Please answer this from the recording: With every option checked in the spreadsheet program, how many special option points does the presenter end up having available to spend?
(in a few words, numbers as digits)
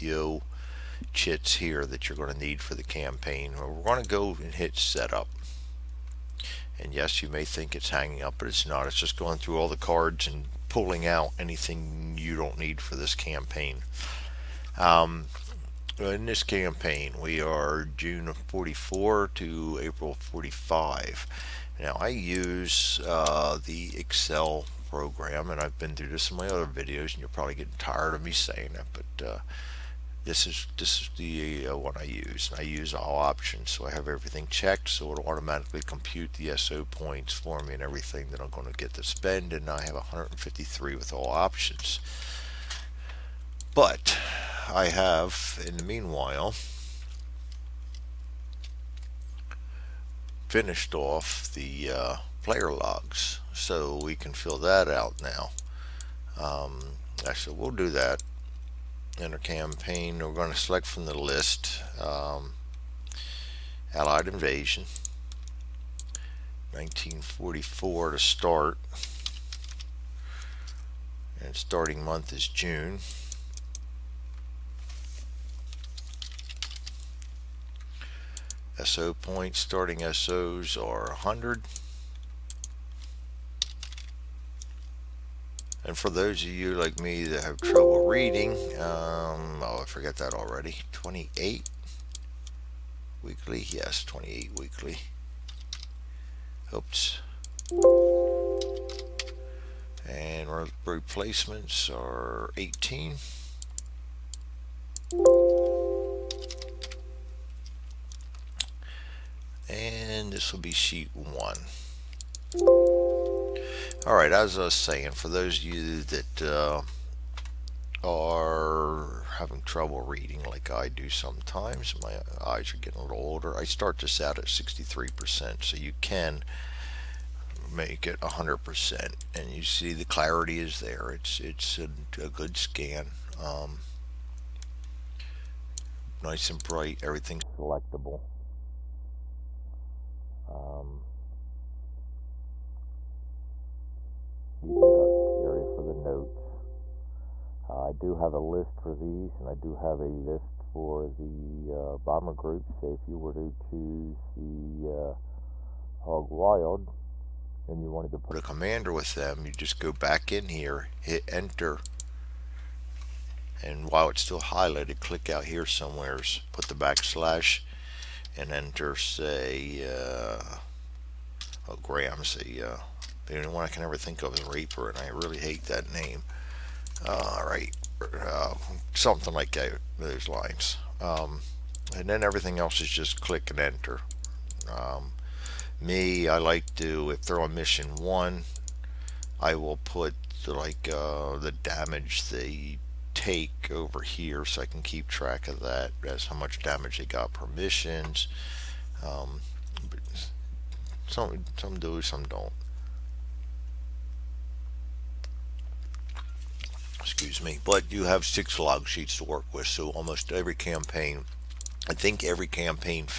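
153.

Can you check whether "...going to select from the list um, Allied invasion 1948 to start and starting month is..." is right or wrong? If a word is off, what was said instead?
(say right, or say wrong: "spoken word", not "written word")
wrong: "1944", not "1948".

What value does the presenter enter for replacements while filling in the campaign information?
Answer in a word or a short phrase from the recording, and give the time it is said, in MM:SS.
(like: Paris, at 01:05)
18, at 01:40.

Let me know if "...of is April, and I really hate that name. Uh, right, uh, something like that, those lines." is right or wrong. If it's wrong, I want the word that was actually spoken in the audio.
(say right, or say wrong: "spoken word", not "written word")
wrong: "Raper", not "April".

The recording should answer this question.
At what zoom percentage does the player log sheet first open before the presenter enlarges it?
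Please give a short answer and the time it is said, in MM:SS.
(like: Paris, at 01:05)
63%, at 02:04.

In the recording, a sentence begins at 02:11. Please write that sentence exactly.
It's, it's a, a good scan.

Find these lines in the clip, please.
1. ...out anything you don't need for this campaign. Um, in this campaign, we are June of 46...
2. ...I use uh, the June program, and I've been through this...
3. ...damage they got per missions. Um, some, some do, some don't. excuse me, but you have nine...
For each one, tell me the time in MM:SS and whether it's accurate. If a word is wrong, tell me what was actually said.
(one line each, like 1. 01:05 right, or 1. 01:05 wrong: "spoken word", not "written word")
1. 00:11 wrong: "44", not "46"
2. 00:22 wrong: "Excel", not "June"
3. 03:16 wrong: "six", not "nine".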